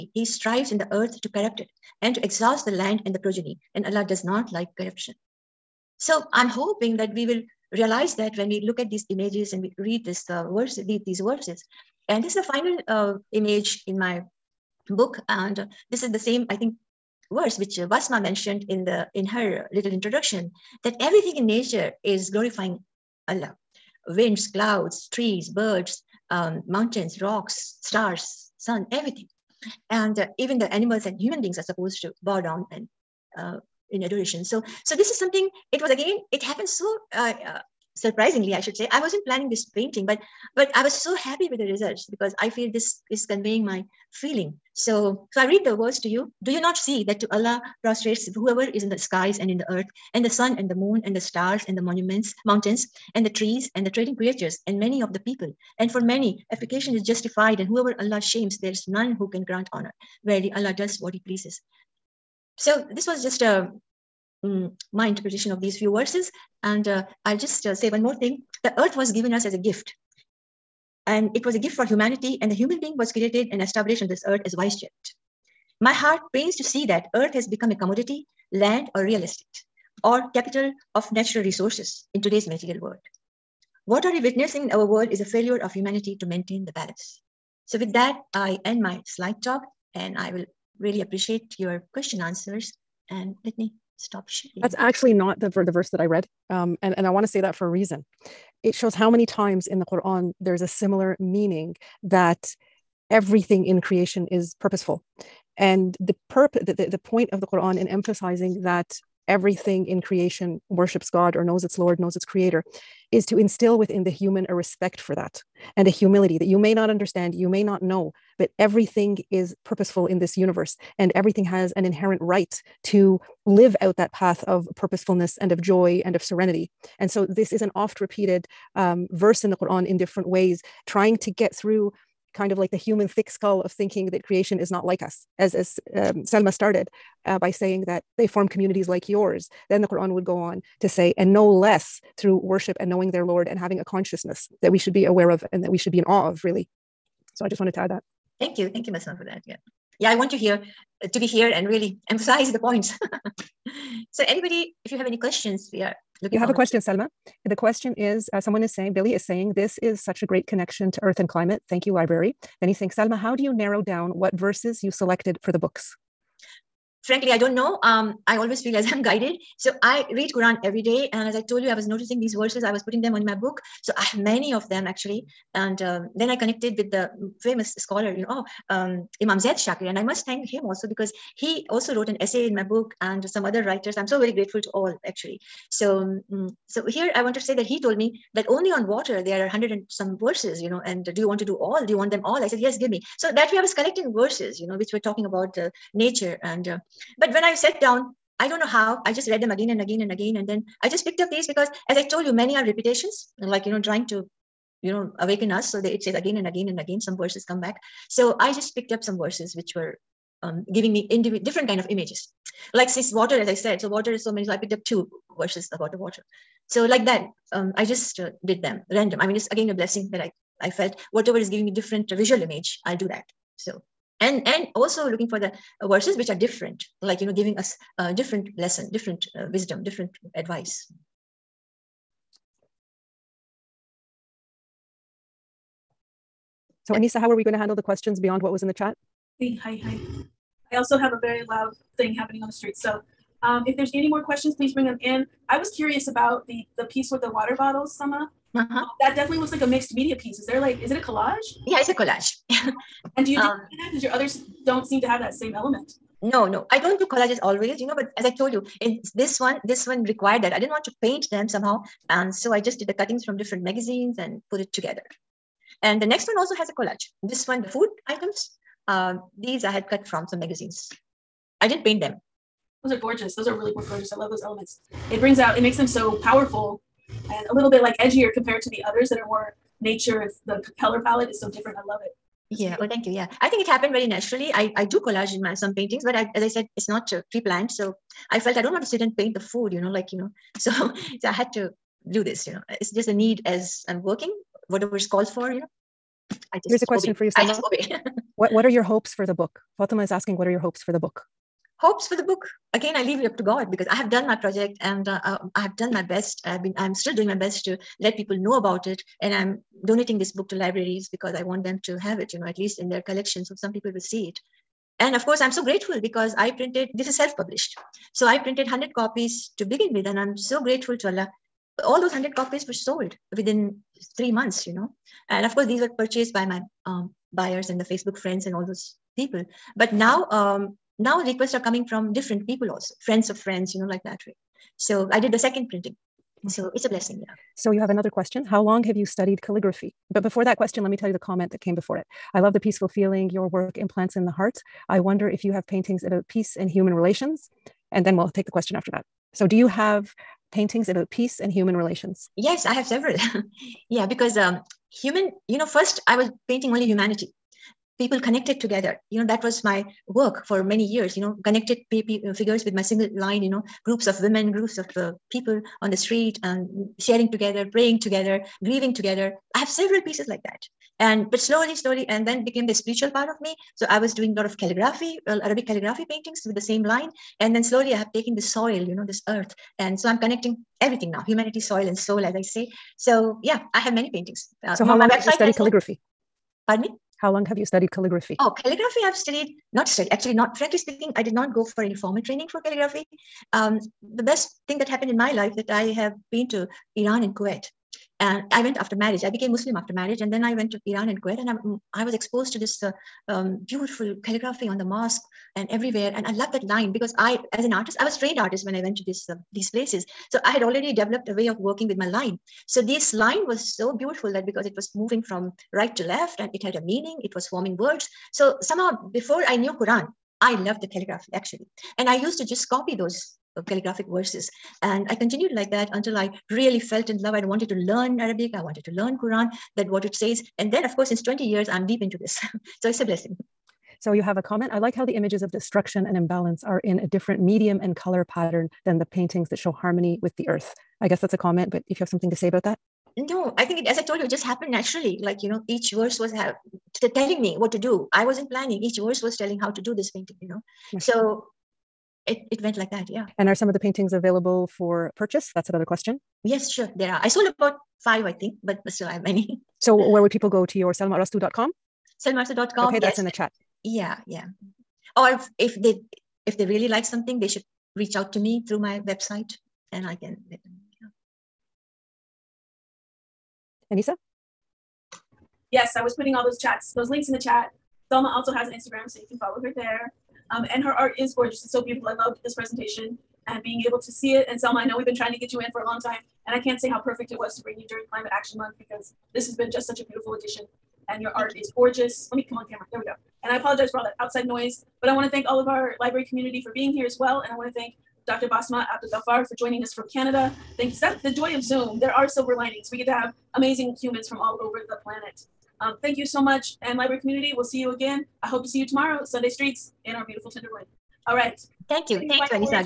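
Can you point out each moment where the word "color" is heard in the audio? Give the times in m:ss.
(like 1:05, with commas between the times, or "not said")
4:40, 7:17.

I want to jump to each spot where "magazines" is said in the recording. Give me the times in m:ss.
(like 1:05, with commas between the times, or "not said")
4:23, 4:30.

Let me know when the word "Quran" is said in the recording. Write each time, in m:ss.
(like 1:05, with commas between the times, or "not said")
1:39, 1:47, 2:09, 2:19, 2:50, 6:59, 7:09.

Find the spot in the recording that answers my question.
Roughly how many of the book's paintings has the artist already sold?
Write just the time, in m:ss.
7:37.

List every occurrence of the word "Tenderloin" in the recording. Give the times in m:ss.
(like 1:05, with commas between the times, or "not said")
8:30.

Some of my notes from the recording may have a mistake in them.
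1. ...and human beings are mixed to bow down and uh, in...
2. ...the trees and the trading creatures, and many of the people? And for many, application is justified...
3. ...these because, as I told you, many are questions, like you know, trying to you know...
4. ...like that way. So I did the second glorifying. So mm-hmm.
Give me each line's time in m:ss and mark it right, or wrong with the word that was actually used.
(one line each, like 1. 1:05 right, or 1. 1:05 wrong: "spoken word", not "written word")
1. 0:31 wrong: "supposed", not "mixed"
2. 0:53 right
3. 3:21 wrong: "repetitions", not "questions"
4. 5:33 wrong: "printing", not "glorifying".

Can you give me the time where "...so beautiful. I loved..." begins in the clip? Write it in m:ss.
8:01.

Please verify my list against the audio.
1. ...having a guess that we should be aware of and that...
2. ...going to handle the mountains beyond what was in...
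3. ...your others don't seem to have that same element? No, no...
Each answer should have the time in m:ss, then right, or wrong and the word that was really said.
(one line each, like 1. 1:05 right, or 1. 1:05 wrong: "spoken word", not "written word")
1. 2:23 wrong: "consciousness", not "guess"
2. 3:57 wrong: "questions", not "mountains"
3. 4:14 right.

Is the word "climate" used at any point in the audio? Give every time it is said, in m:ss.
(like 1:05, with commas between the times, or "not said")
2:41, 8:08.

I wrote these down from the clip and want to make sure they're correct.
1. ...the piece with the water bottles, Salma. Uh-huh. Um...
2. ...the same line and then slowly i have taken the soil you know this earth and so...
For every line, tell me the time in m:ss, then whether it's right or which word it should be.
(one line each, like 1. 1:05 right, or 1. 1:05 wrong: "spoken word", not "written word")
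1. 4:06 right
2. 6:16 right.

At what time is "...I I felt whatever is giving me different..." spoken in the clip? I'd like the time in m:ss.
3:40.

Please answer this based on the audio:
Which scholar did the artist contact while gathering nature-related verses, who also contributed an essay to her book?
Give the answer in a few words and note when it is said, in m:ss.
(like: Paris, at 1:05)
Imam Zaid Shakir, at 2:59.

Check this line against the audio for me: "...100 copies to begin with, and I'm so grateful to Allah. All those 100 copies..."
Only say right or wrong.
right.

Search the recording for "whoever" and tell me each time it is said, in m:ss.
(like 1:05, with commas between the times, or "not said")
0:48, 0:57.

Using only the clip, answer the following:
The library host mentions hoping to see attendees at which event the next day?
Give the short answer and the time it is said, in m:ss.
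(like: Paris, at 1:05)
Sunday Streets, at 8:29.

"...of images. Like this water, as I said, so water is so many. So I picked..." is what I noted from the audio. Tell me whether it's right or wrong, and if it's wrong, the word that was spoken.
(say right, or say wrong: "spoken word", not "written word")
right.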